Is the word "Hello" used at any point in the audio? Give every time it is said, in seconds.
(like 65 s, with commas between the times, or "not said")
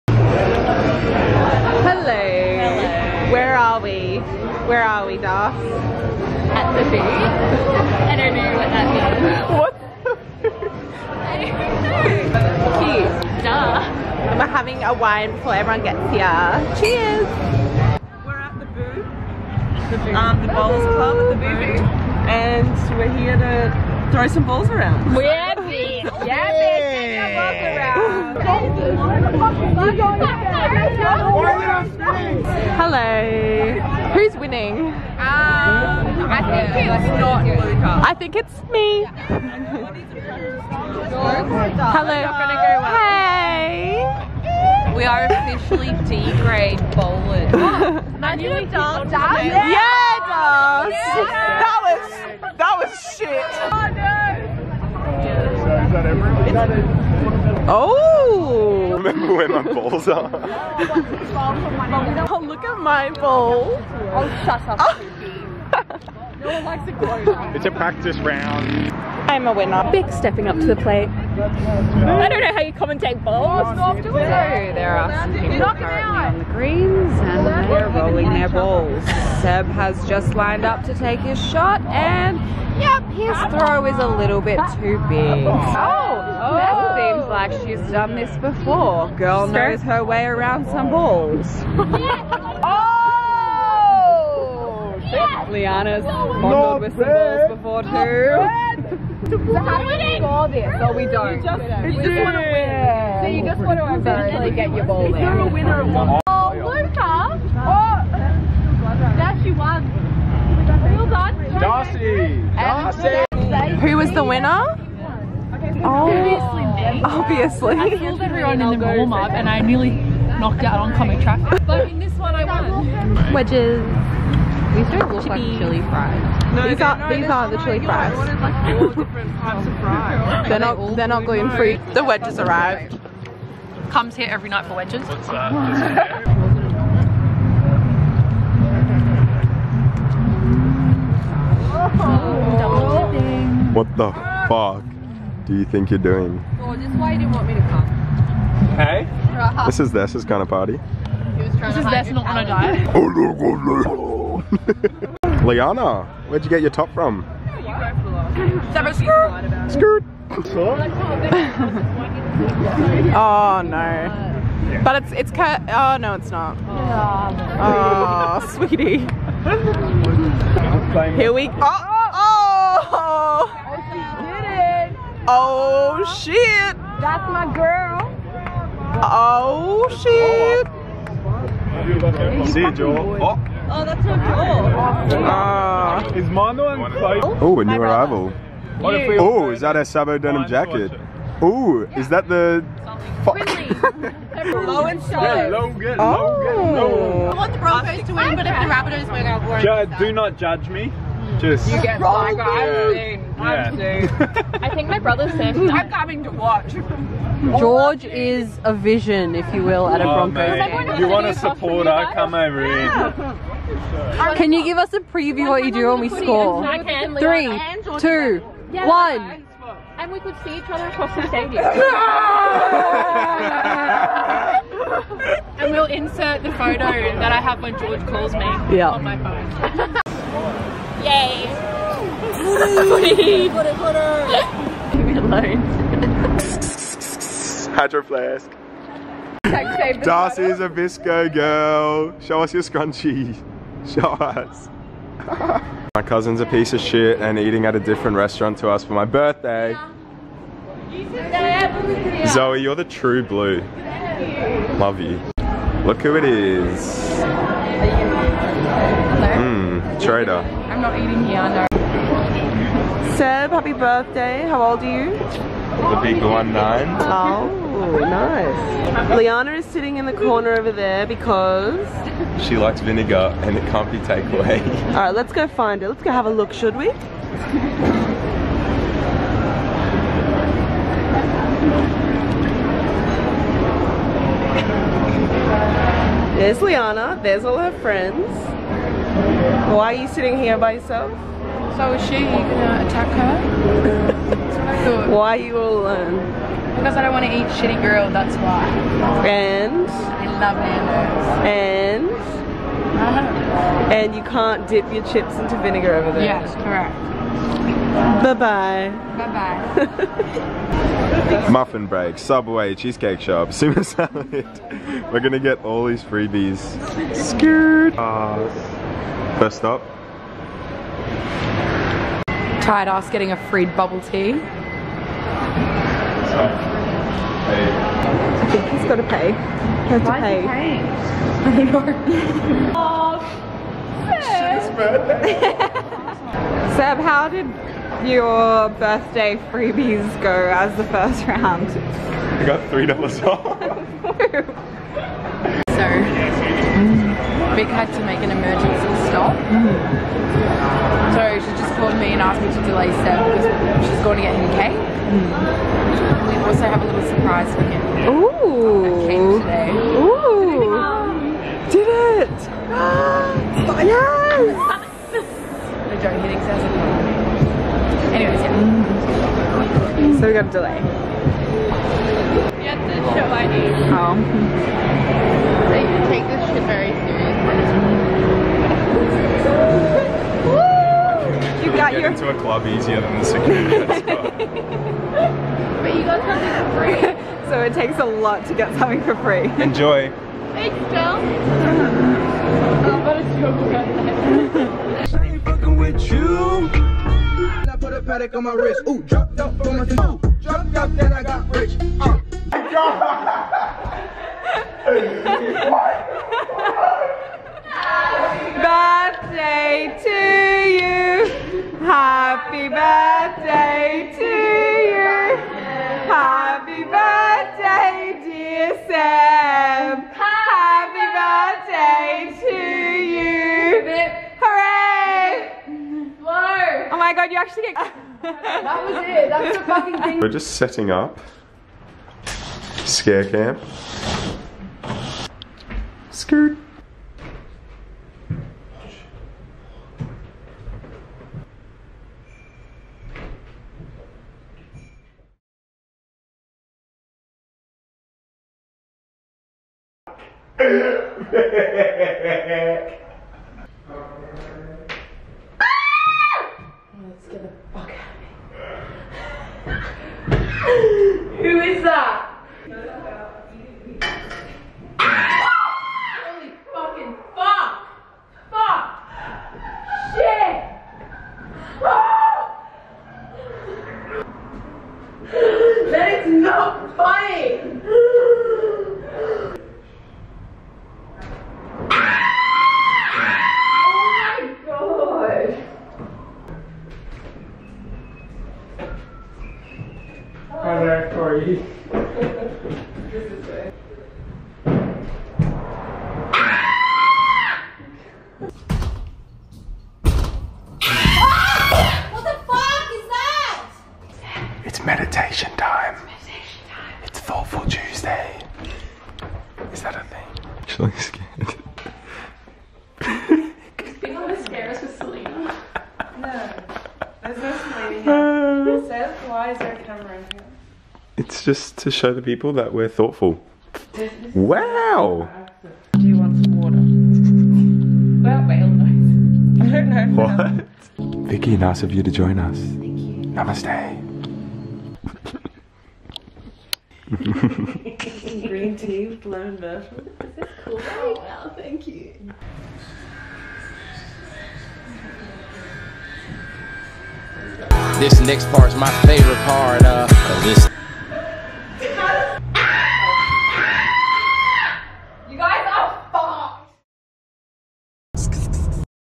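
32 s, 41 s.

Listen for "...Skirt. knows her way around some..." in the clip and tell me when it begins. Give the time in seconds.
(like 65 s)
89 s.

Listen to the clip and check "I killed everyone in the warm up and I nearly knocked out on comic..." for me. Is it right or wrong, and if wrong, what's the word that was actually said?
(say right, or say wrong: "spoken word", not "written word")
right.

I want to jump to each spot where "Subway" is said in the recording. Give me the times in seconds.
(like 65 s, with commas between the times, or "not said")
312 s.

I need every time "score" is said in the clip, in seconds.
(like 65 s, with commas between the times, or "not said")
100 s, 216 s.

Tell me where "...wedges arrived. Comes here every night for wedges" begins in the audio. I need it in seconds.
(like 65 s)
132 s.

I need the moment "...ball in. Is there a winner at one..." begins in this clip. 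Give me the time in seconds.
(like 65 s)
104 s.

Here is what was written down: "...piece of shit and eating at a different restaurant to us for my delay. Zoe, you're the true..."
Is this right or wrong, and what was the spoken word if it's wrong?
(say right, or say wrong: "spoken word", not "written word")
wrong: "birthday", not "delay".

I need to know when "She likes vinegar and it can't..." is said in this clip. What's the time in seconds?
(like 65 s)
272 s.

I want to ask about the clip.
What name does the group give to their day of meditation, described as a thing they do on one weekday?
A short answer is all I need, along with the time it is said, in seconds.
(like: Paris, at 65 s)
Thoughtful Tuesday, at 507 s.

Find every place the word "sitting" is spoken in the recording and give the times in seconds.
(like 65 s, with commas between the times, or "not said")
269 s, 290 s.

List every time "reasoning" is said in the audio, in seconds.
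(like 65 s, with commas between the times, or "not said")
not said.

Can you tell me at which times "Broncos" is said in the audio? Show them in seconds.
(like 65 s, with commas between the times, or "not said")
197 s, 210 s.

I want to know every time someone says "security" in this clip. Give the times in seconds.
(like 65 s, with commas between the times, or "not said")
383 s.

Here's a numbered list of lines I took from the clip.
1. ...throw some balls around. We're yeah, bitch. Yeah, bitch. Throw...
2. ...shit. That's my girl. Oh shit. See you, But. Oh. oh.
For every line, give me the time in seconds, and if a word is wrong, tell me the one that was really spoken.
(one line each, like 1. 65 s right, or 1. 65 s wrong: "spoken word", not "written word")
1. 24 s right
2. 176 s wrong: "Joel", not "But".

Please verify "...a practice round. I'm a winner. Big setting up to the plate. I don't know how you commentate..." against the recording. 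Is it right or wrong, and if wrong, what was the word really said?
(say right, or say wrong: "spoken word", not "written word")
wrong: "stepping", not "setting".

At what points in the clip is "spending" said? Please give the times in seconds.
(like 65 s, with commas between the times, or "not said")
not said.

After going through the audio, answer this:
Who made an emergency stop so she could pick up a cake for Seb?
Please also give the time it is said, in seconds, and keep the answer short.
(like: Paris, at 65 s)
Vic, at 347 s.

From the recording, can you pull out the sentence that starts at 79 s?
Seb has just lined up to take his shot and yep, his throw is a little bit too big.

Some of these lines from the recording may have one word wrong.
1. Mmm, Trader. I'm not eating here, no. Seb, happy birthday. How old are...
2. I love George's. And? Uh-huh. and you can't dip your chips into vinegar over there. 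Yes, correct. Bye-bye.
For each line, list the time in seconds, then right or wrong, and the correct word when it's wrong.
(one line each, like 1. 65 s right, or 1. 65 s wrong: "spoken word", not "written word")
1. 259 s right
2. 299 s wrong: "Nando", not "George".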